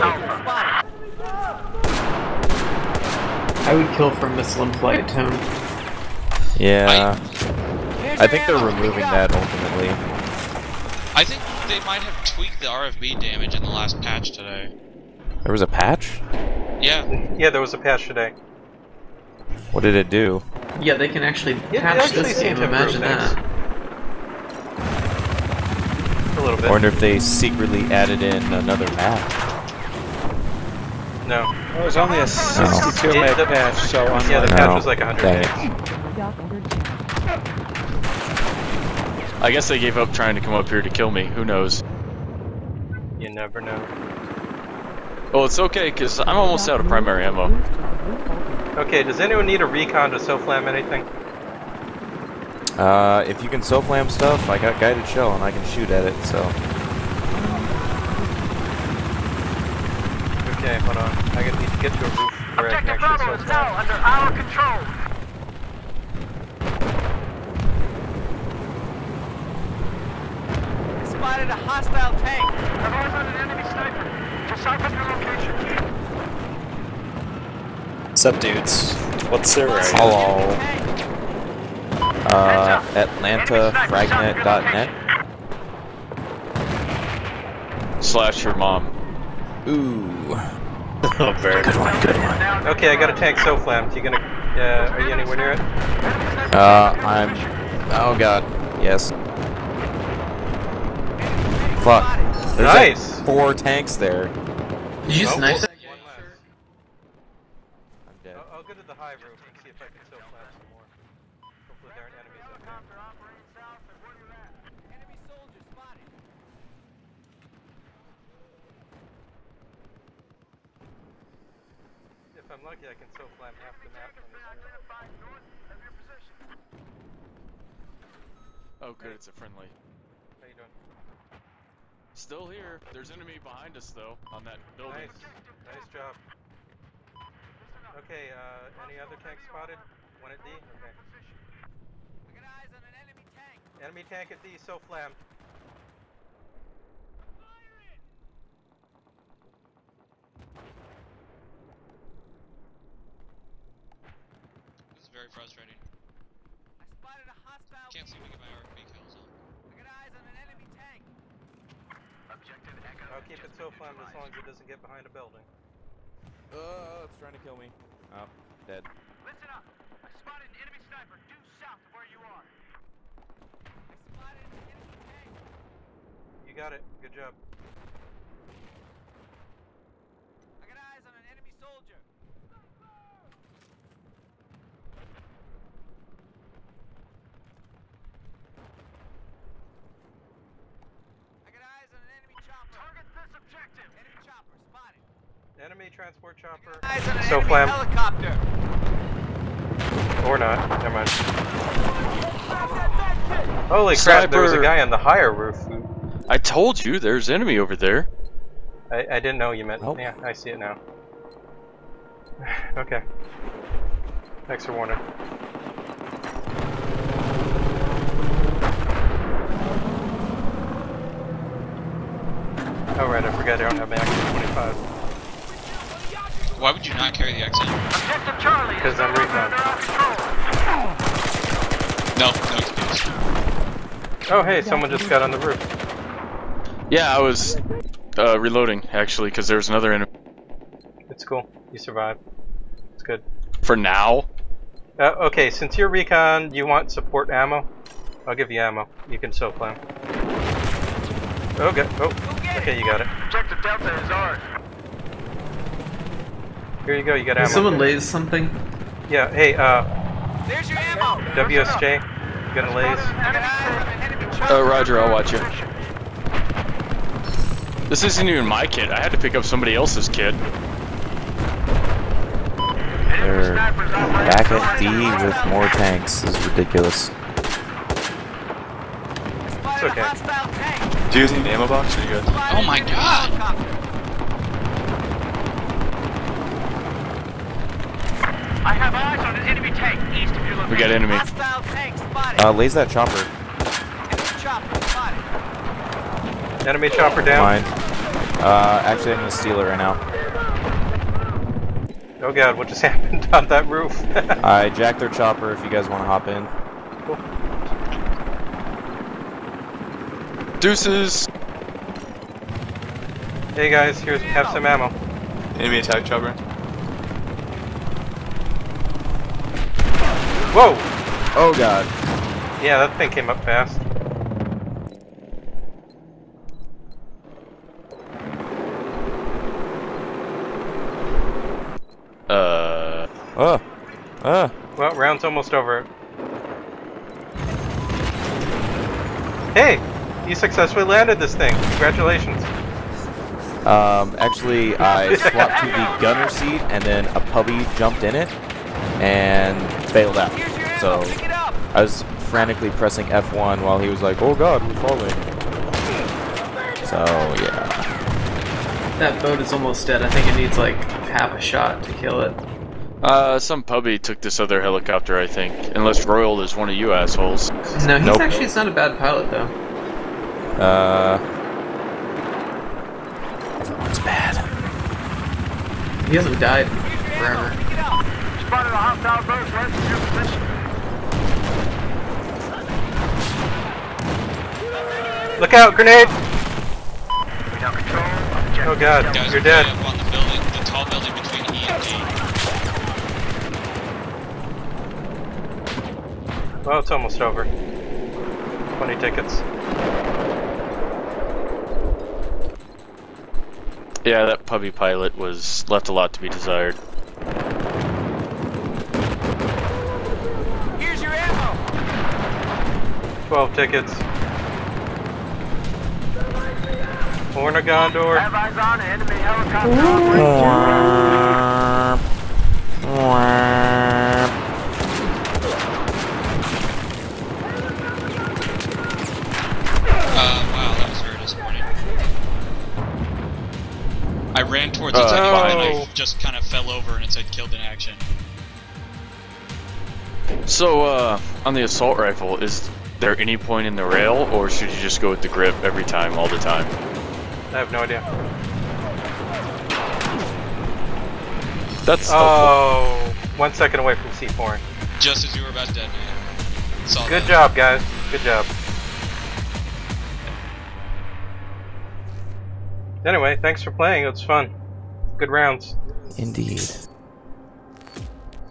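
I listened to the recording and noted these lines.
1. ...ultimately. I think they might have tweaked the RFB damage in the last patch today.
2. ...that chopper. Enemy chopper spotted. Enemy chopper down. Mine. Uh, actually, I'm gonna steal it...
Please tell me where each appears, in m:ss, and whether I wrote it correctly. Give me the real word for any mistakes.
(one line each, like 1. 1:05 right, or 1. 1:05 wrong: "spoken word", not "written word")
1. 0:09 right
2. 4:52 right.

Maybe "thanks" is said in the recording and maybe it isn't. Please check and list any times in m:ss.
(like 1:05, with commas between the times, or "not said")
3:34, 7:43.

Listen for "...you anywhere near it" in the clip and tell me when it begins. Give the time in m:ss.
1:35.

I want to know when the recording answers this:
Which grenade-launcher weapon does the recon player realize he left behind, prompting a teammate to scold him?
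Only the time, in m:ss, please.
3:43.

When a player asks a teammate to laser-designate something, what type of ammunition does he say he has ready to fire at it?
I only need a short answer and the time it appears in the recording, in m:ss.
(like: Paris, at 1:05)
guided shell, at 0:54.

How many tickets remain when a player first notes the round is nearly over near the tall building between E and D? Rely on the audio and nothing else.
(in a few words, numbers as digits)
20.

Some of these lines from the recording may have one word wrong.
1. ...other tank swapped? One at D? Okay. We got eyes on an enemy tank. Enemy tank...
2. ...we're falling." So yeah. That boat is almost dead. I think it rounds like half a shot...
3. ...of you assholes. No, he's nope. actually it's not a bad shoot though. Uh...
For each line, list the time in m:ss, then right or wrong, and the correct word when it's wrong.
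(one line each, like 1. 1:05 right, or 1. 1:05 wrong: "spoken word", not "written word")
1. 2:18 wrong: "spotted", not "swapped"
2. 5:54 wrong: "needs", not "rounds"
3. 6:06 wrong: "pilot", not "shoot".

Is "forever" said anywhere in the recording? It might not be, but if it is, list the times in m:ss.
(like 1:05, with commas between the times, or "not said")
6:17.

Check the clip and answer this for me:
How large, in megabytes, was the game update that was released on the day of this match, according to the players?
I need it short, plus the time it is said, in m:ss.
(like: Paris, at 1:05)
62, at 0:32.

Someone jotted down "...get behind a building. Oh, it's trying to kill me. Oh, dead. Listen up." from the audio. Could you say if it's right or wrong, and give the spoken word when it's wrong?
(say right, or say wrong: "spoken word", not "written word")
right.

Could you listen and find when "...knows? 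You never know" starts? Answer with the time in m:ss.
0:41.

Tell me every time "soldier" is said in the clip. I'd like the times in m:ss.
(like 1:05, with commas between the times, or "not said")
1:55, 3:01.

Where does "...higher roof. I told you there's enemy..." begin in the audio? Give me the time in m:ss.
3:24.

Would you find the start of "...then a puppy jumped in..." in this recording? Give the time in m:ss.
5:46.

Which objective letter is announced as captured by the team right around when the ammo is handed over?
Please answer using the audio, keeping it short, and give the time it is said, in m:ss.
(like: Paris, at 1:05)
Delta, at 4:13.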